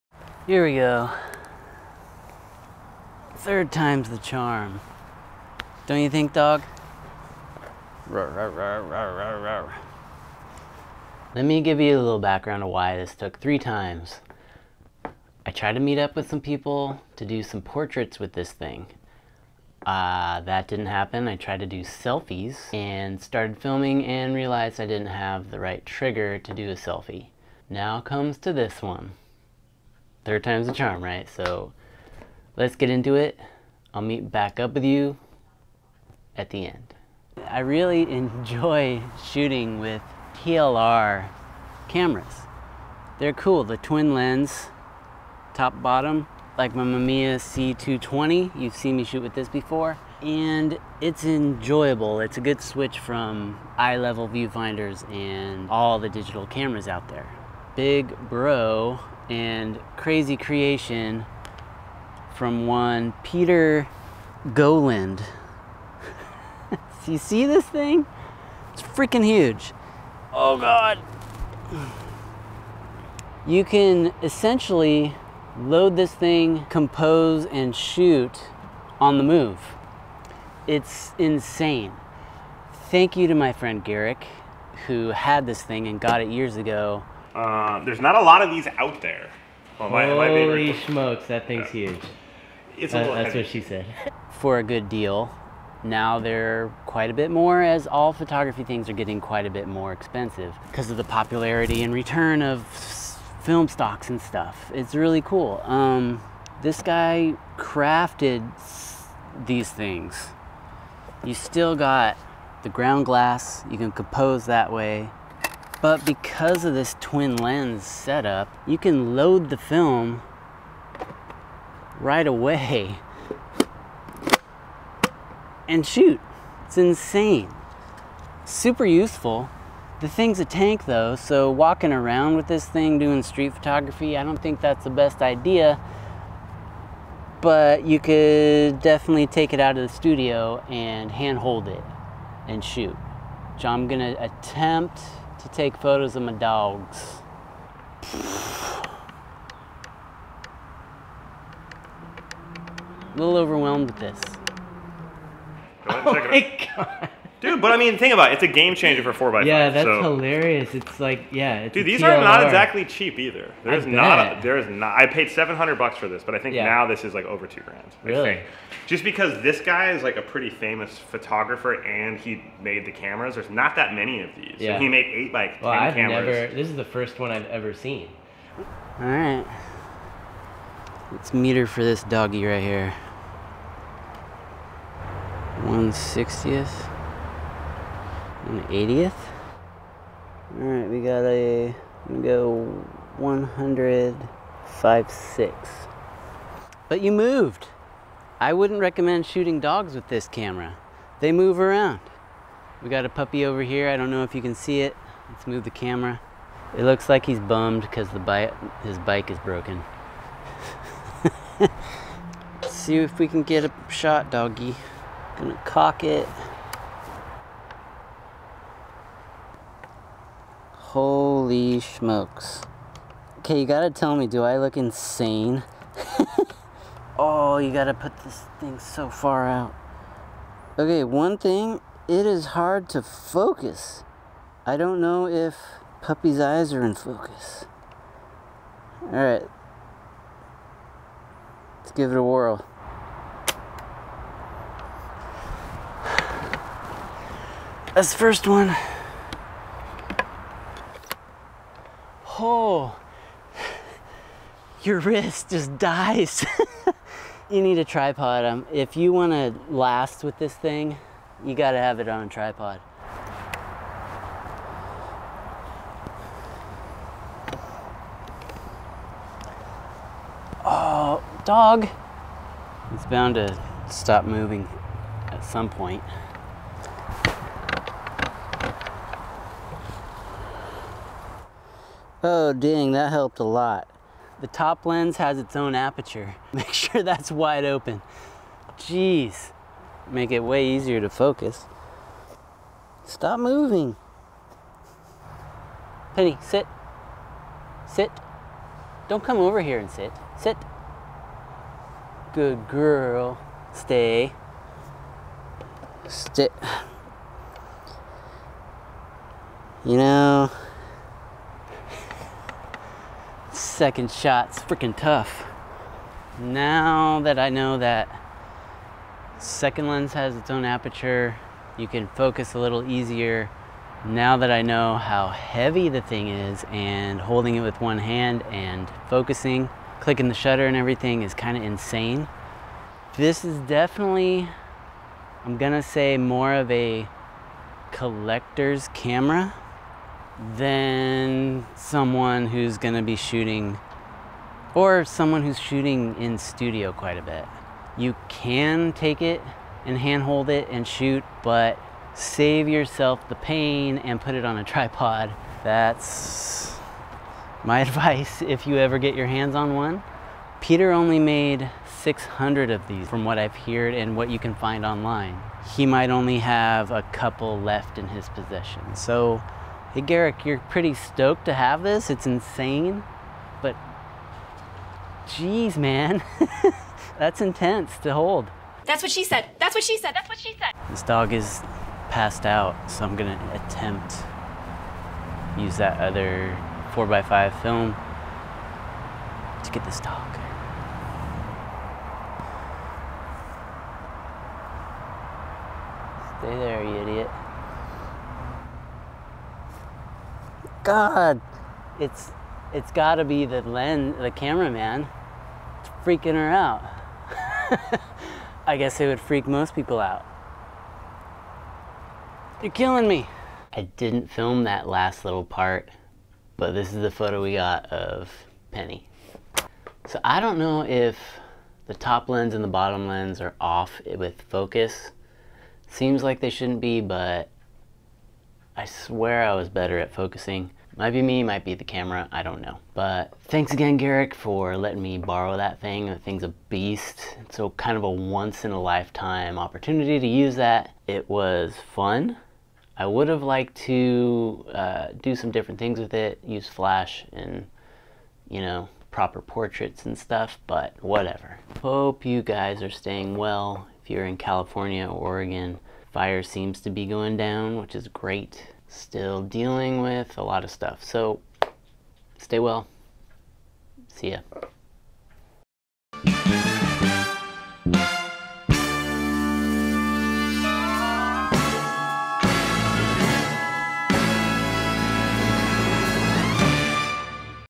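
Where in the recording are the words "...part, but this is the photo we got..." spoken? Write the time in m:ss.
6:55.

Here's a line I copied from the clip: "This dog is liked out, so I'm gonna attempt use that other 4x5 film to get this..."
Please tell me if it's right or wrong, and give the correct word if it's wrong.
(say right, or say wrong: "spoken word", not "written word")
wrong: "passed", not "liked".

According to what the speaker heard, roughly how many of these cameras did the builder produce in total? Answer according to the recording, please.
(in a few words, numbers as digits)
600.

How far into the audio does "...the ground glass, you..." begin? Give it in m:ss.
1:52.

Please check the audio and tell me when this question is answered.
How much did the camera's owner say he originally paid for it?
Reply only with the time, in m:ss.
2:45.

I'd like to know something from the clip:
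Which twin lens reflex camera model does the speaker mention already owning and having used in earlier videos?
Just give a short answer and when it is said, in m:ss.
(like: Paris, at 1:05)
Mamiya C220, at 0:46.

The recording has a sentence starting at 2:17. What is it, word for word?
But you could definitely take it out of the studio and handhold it and shoot.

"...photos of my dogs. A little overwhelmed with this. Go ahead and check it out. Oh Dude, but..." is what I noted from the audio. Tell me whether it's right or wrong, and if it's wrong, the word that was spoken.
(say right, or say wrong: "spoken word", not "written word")
right.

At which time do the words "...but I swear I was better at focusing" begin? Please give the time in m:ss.
7:07.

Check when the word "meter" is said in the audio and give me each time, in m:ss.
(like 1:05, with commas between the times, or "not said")
3:01.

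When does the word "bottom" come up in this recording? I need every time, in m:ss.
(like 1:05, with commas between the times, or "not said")
0:45, 7:02.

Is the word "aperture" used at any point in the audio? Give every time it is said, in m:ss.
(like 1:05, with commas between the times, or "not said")
4:45, 5:20.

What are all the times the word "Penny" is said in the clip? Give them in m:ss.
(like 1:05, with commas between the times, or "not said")
4:56, 6:58.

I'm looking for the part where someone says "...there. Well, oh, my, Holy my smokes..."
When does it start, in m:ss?
1:29.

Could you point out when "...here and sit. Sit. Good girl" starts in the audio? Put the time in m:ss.
4:59.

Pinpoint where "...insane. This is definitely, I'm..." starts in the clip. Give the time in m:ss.
5:31.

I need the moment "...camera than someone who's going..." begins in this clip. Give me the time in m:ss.
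5:38.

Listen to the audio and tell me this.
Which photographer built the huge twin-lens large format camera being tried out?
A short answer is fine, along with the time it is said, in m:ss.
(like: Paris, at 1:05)
Peter Gowland, at 1:03.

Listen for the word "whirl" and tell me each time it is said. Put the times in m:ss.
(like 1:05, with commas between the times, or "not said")
4:02.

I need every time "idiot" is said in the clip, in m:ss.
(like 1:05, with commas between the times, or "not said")
6:37.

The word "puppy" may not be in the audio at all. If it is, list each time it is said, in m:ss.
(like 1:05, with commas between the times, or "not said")
3:23, 3:56.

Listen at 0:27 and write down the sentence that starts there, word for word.
Now comes to this one third time's a charm, right?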